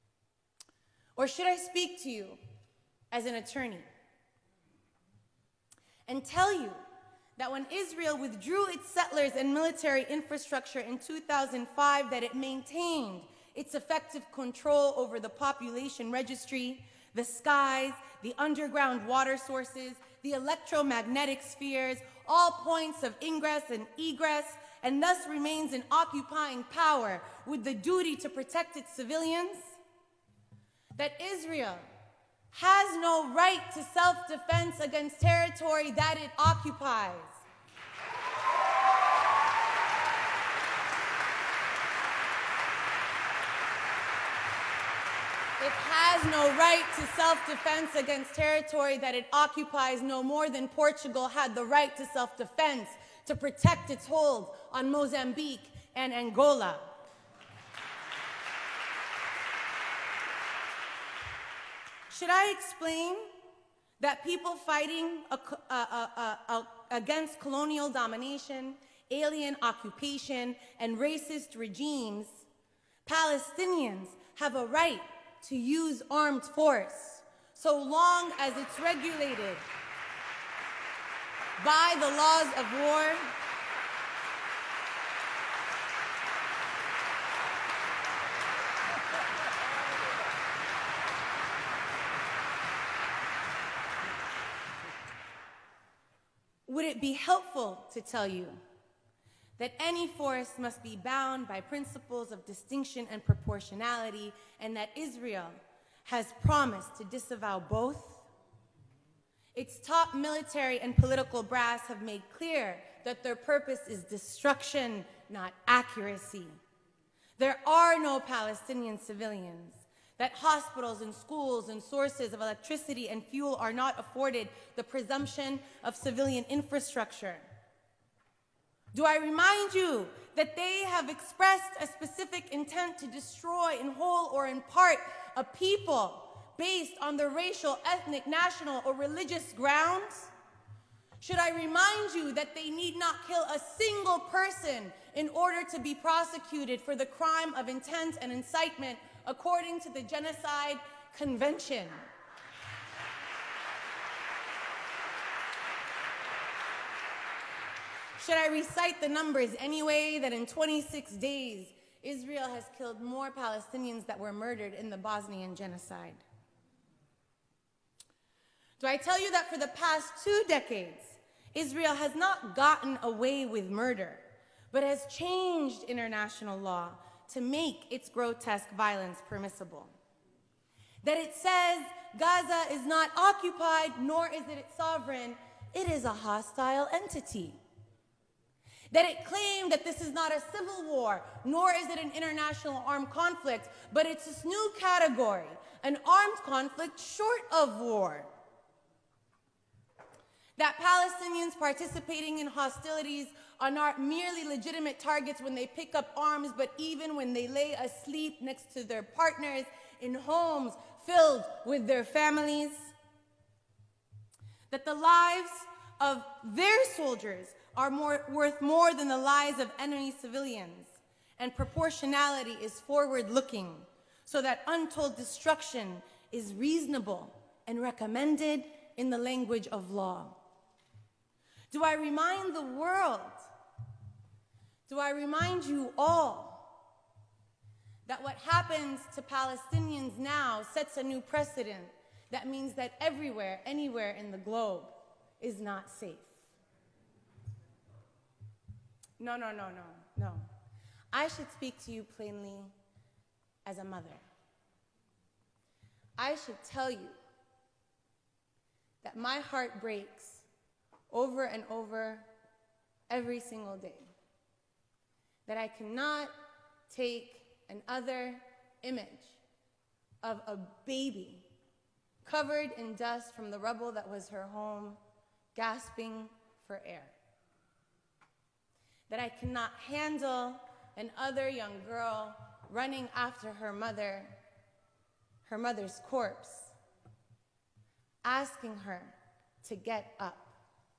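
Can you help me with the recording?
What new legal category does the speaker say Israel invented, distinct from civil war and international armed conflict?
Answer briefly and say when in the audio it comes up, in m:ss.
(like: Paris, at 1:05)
Armed conflict short of war, at 3:15.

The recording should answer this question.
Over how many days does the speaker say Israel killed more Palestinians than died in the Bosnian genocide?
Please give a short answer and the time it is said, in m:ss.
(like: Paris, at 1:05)
26, at 2:40.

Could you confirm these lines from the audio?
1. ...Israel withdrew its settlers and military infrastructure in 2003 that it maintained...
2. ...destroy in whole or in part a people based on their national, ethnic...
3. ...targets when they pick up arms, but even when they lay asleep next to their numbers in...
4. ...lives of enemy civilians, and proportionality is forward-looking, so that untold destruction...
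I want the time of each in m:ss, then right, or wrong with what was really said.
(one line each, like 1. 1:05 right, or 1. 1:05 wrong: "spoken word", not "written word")
1. 0:07 wrong: "2005", not "2003"
2. 2:13 wrong: "racial", not "national"
3. 3:24 wrong: "partners", not "numbers"
4. 3:39 right.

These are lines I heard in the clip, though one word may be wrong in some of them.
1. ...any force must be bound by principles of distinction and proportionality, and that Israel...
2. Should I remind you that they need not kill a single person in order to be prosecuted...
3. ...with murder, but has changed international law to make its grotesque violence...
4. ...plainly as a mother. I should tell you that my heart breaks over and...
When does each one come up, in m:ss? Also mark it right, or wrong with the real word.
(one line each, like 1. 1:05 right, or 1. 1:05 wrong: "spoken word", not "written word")
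1. 1:39 right
2. 2:21 right
3. 2:53 right
4. 4:12 right.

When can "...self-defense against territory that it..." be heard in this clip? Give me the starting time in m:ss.
0:47.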